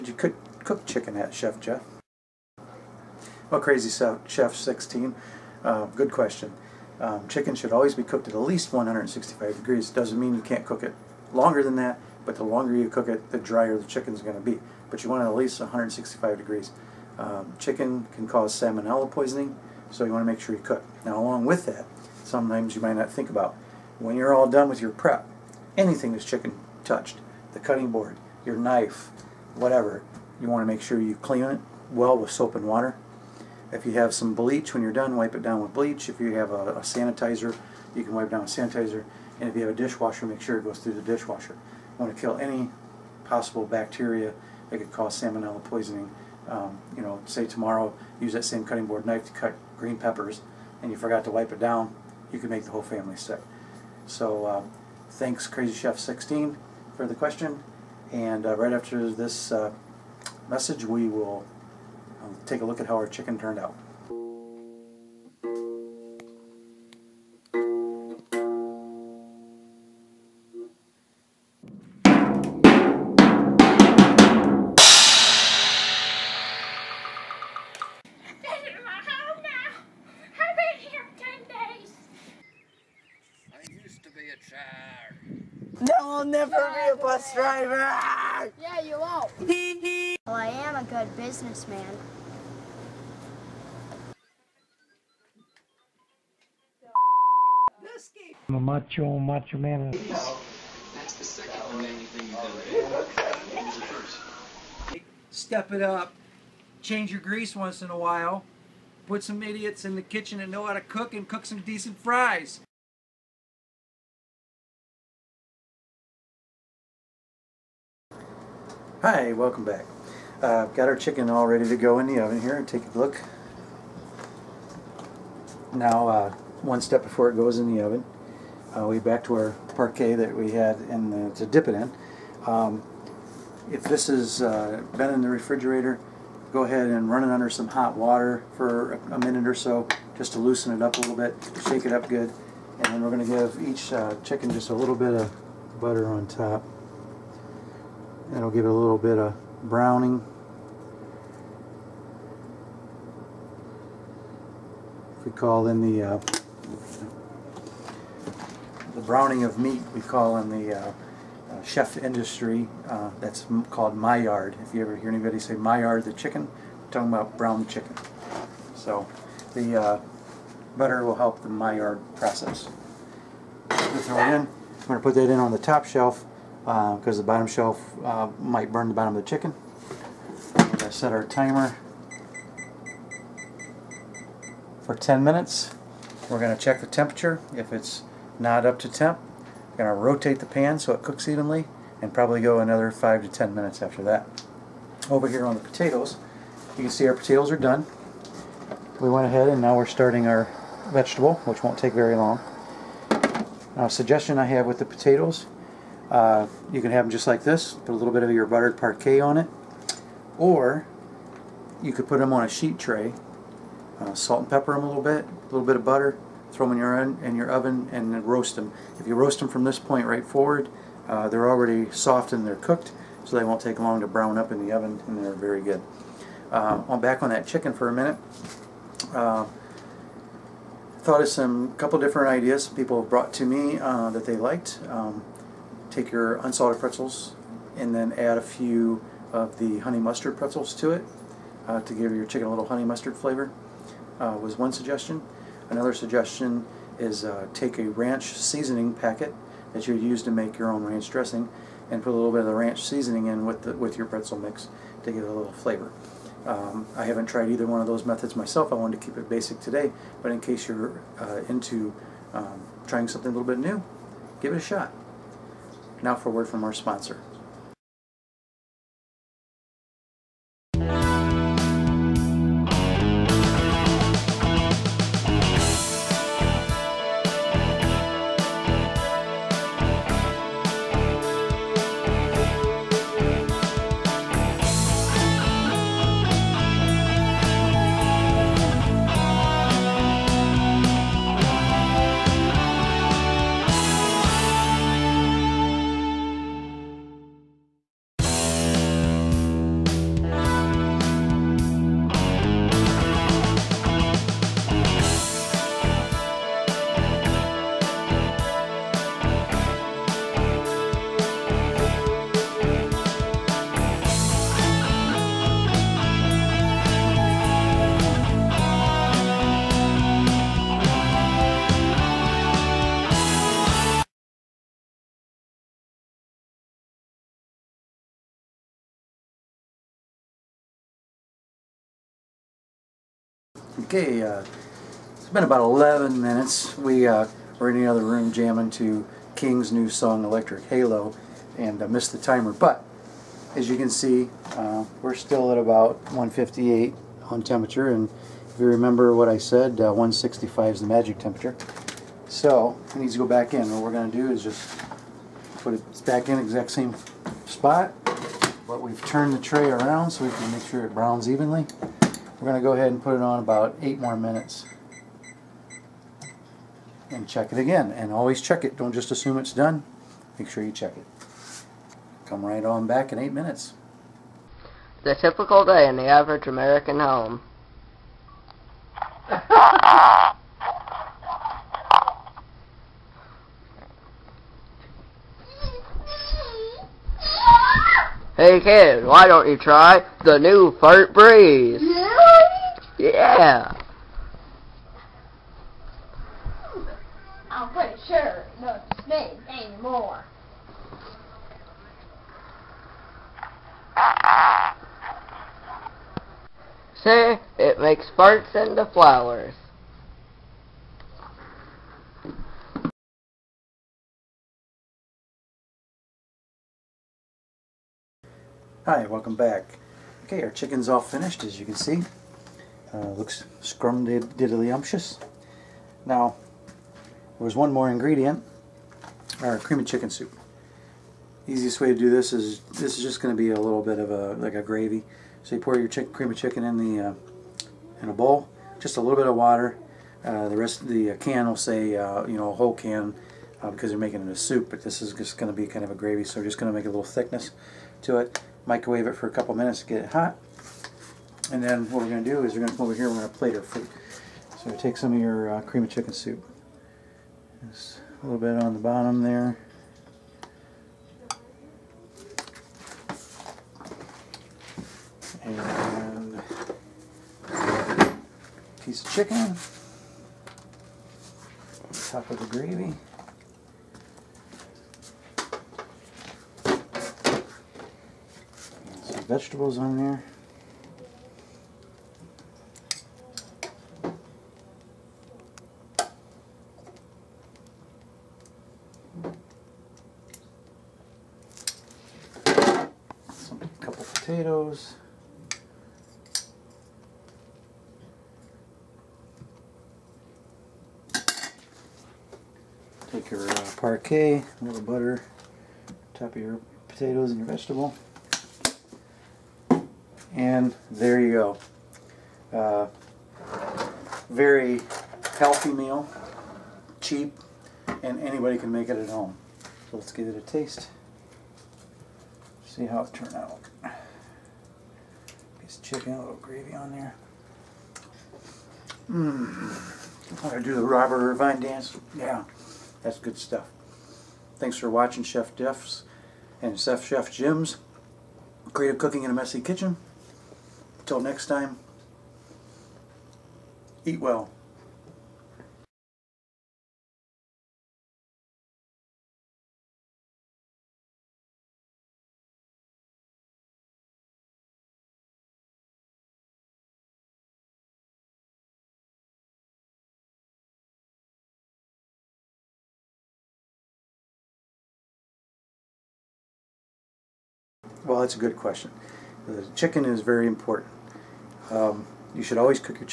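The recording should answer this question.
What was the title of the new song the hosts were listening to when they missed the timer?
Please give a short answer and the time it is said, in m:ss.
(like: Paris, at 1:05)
Electric Halo, at 5:40.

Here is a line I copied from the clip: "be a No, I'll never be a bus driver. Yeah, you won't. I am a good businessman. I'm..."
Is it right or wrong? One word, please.
right.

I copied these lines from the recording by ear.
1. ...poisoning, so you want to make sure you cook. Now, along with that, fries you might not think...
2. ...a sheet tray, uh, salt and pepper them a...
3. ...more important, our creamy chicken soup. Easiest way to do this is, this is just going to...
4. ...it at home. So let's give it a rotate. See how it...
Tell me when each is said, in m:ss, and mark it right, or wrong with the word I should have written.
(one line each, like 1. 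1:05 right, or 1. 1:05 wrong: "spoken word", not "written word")
1. 0:19 wrong: "sometimes", not "fries"
2. 3:32 right
3. 7:07 wrong: "ingredient", not "important"
4. 8:38 wrong: "taste", not "rotate".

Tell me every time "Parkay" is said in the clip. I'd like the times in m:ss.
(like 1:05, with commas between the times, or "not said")
2:09, 3:28.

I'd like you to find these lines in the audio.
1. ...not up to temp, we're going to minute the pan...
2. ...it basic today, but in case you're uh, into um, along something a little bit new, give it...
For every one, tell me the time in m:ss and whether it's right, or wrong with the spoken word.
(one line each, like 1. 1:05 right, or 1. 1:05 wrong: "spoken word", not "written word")
1. 3:08 wrong: "rotate", not "minute"
2. 4:19 wrong: "trying", not "along".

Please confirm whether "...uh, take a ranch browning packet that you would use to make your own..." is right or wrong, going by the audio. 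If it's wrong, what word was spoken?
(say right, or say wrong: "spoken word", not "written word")
wrong: "seasoning", not "browning".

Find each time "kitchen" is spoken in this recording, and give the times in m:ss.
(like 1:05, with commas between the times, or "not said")
1:50, 8:59.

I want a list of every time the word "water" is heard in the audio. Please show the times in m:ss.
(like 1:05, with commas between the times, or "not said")
0:32, 2:17, 7:19.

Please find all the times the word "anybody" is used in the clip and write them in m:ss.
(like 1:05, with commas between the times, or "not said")
2:45, 8:38.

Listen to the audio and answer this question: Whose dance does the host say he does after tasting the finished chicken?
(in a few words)
Robert Irvine.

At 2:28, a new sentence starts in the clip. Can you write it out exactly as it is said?
That'll give it a little bit of browning.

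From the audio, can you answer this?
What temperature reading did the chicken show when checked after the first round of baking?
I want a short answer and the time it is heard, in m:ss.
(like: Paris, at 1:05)
158, at 5:46.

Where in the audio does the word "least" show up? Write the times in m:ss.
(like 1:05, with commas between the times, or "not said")
0:08, 0:15.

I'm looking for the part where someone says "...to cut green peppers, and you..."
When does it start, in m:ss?
0:49.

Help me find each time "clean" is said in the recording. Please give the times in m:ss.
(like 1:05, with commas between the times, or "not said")
0:31.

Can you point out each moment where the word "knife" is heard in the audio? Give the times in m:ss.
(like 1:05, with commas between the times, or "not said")
0:28, 0:49.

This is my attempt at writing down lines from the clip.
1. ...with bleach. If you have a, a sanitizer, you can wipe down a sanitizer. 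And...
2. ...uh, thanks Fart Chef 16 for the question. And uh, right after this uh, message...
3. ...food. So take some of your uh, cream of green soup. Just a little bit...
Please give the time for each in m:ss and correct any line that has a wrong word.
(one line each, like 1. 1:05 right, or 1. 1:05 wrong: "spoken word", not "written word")
1. 0:35 right
2. 0:54 wrong: "Crazy", not "Fart"
3. 7:33 wrong: "chicken", not "green".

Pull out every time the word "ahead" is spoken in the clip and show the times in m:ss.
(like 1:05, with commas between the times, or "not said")
2:16, 3:19, 6:02.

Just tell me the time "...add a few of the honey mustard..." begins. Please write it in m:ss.
3:58.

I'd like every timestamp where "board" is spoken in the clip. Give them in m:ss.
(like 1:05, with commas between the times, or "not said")
0:27, 0:48.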